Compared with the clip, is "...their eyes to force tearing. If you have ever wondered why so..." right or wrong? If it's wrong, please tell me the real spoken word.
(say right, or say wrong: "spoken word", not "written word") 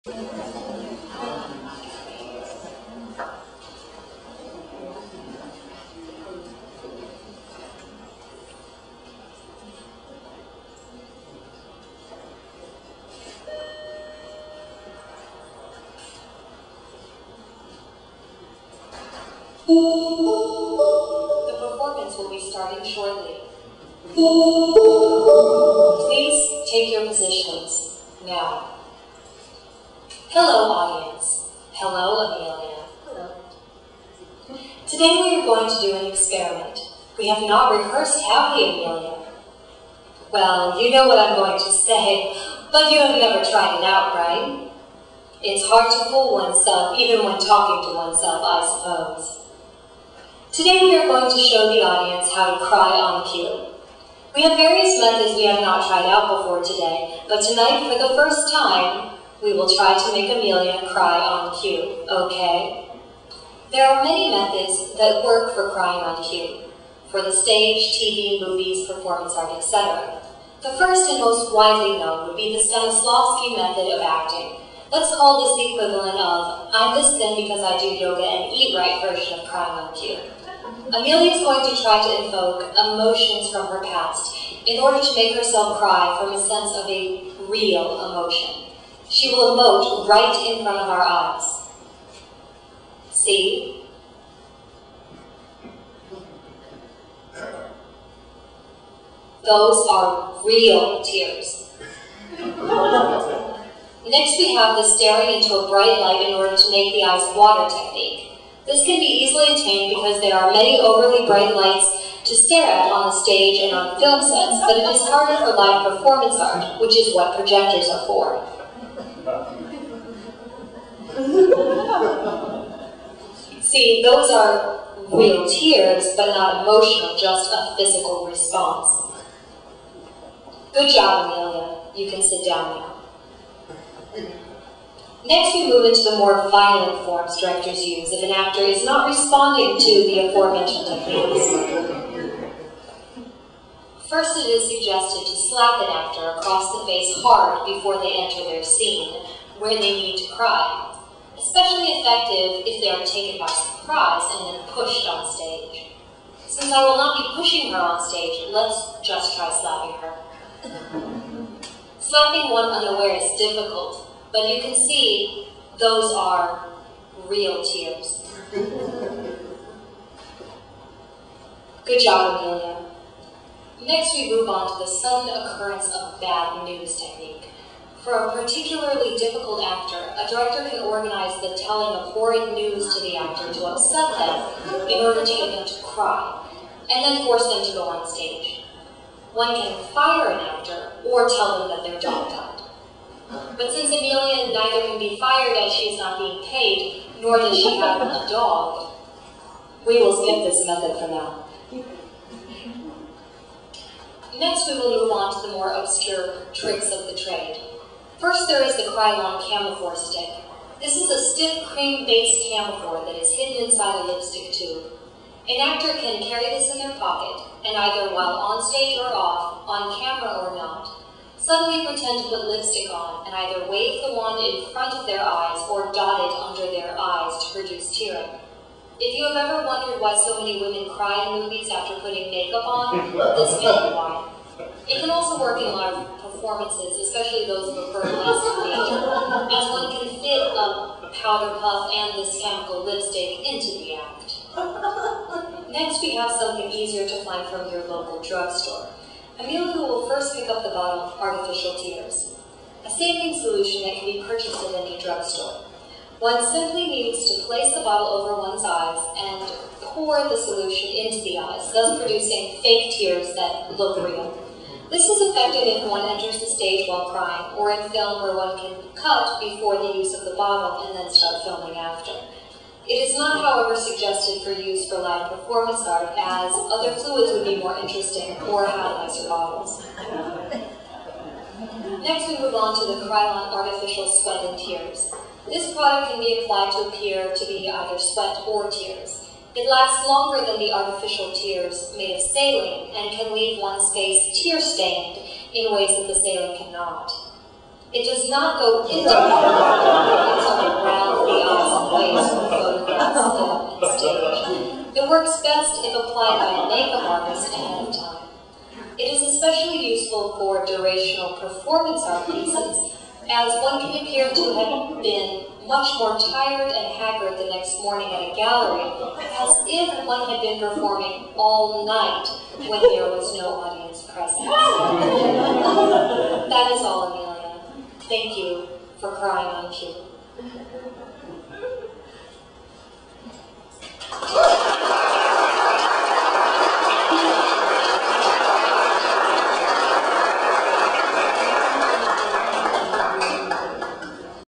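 wrong: "produce", not "force".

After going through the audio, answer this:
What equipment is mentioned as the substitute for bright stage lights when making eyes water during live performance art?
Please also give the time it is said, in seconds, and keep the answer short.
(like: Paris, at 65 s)
projectors, at 117 s.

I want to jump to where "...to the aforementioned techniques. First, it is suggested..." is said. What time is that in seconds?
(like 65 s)
139 s.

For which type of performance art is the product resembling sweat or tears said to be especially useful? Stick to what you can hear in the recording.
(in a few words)
durational.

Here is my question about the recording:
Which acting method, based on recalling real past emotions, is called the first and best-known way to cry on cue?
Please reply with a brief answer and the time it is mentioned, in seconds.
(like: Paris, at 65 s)
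Stanislavski method, at 72 s.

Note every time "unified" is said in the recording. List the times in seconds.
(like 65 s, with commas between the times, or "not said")
not said.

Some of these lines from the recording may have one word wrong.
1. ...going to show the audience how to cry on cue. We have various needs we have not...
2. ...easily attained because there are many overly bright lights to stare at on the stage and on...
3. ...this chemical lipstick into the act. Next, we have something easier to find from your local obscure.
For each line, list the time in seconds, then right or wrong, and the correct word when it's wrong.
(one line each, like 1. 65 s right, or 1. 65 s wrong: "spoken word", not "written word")
1. 51 s wrong: "methods", not "needs"
2. 109 s right
3. 242 s wrong: "drugstore", not "obscure".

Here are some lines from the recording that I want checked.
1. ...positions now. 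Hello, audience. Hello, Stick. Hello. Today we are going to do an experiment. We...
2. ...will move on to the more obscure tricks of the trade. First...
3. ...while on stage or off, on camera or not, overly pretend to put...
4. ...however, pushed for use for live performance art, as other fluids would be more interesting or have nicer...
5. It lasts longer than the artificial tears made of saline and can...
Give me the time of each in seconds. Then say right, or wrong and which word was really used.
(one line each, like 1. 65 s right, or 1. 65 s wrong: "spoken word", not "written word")
1. 27 s wrong: "Amelia", not "Stick"
2. 204 s right
3. 218 s wrong: "suddenly", not "overly"
4. 273 s wrong: "suggested", not "pushed"
5. 289 s right.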